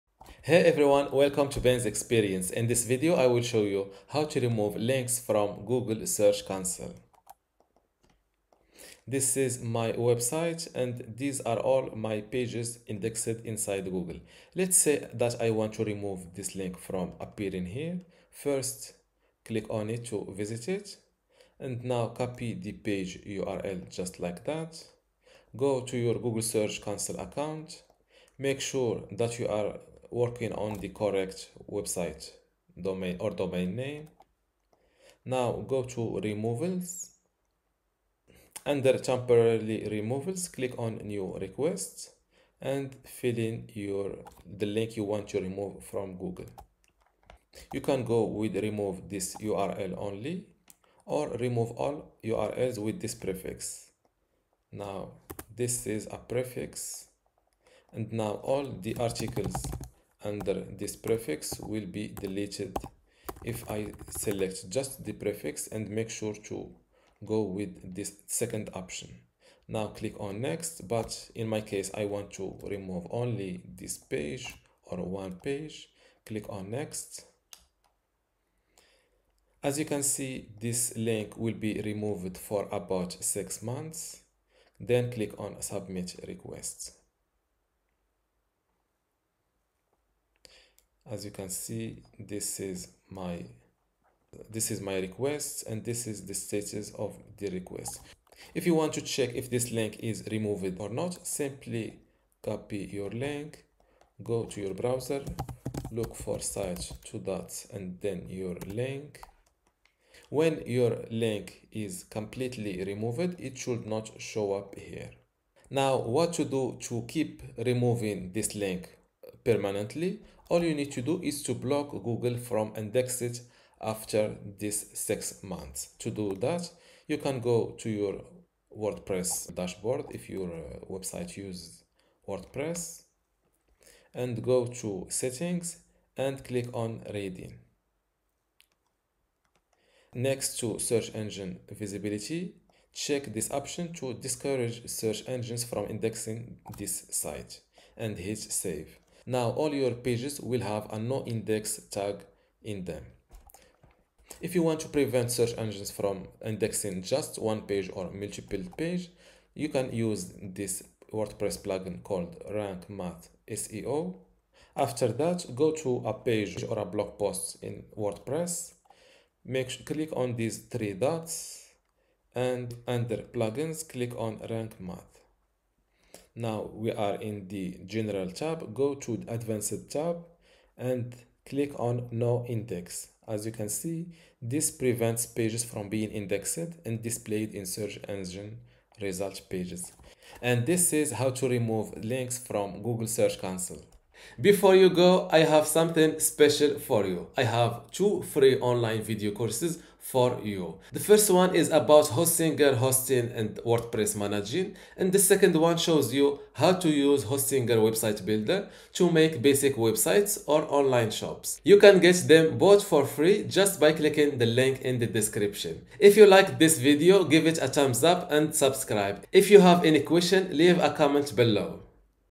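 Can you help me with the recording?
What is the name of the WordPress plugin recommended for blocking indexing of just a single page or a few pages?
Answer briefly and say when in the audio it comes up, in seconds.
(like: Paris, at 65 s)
Rank Math SEO, at 162 s.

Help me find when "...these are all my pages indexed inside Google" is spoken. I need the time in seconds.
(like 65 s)
11 s.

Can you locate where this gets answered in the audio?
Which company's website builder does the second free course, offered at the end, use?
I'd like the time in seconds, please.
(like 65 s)
207 s.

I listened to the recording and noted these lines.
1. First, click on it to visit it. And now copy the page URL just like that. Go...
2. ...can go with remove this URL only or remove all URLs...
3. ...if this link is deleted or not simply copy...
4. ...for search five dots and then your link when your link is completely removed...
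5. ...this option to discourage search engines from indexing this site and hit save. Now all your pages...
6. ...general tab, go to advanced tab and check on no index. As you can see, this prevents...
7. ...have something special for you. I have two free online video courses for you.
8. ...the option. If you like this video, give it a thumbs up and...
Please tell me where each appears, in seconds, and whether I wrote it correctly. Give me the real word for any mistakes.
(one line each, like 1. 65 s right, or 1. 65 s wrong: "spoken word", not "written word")
1. 18 s right
2. 47 s right
3. 99 s wrong: "removed", not "deleted"
4. 106 s wrong: "two", not "five"
5. 143 s right
6. 177 s wrong: "click", not "check"
7. 195 s right
8. 214 s wrong: "description", not "option".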